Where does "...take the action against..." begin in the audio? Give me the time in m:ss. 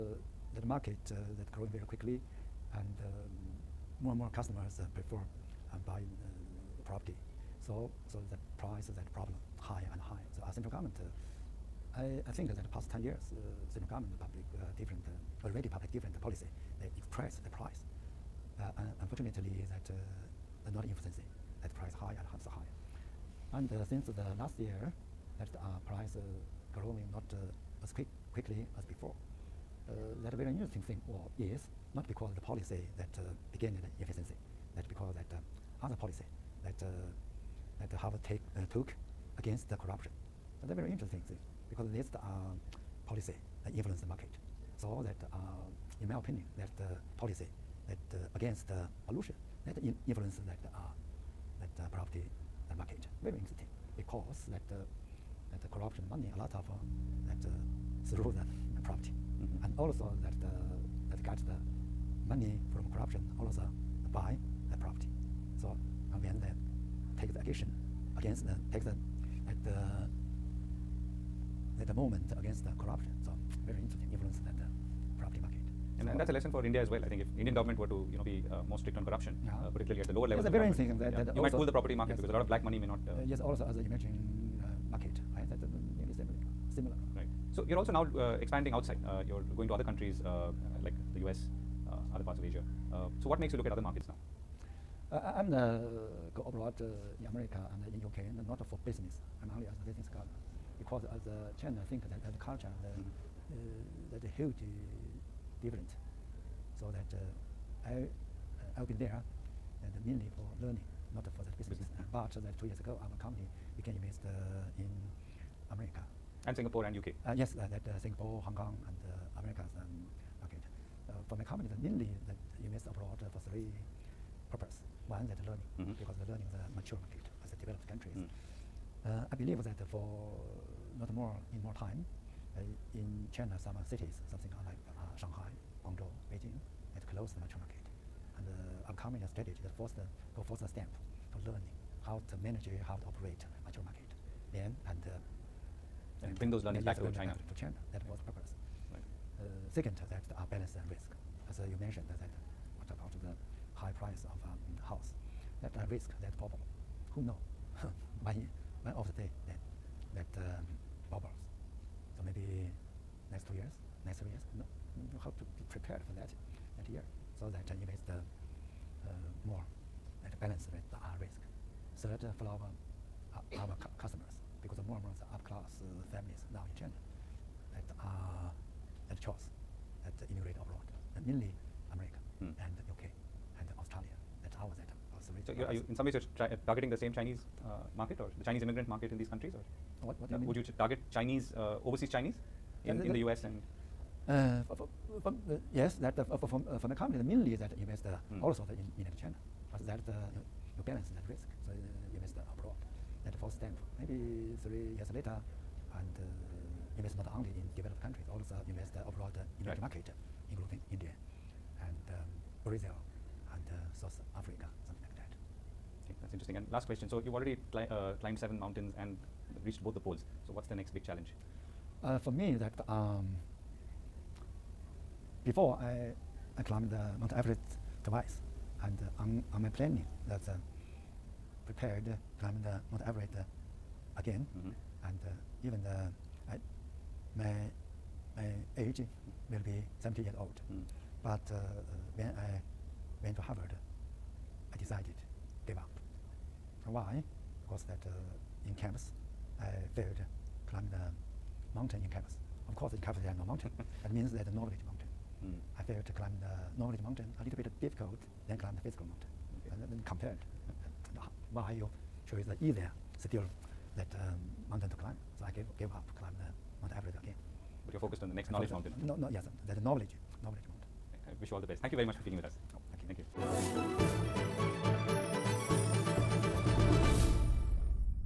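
1:07.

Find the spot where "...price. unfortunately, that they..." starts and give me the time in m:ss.
0:17.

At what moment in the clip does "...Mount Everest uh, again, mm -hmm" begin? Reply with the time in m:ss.
3:52.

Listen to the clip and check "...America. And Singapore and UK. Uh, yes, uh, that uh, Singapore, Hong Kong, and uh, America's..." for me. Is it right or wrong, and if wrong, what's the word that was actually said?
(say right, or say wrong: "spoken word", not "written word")
right.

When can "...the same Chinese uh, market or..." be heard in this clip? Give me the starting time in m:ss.
3:06.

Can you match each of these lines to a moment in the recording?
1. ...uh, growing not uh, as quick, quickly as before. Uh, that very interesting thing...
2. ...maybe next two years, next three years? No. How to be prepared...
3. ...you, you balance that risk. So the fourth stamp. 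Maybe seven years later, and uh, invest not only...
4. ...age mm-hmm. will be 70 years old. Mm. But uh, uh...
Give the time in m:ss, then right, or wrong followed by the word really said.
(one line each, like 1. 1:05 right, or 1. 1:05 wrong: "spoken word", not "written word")
1. 0:26 right
2. 2:42 right
3. 3:20 wrong: "three", not "seven"
4. 3:58 right.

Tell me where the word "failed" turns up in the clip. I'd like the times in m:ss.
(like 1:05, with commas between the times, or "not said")
4:09, 4:15.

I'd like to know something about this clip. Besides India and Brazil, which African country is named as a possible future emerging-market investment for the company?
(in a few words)
South Africa.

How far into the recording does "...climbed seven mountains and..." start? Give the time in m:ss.
3:38.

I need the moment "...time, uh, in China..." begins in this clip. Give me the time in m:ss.
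2:11.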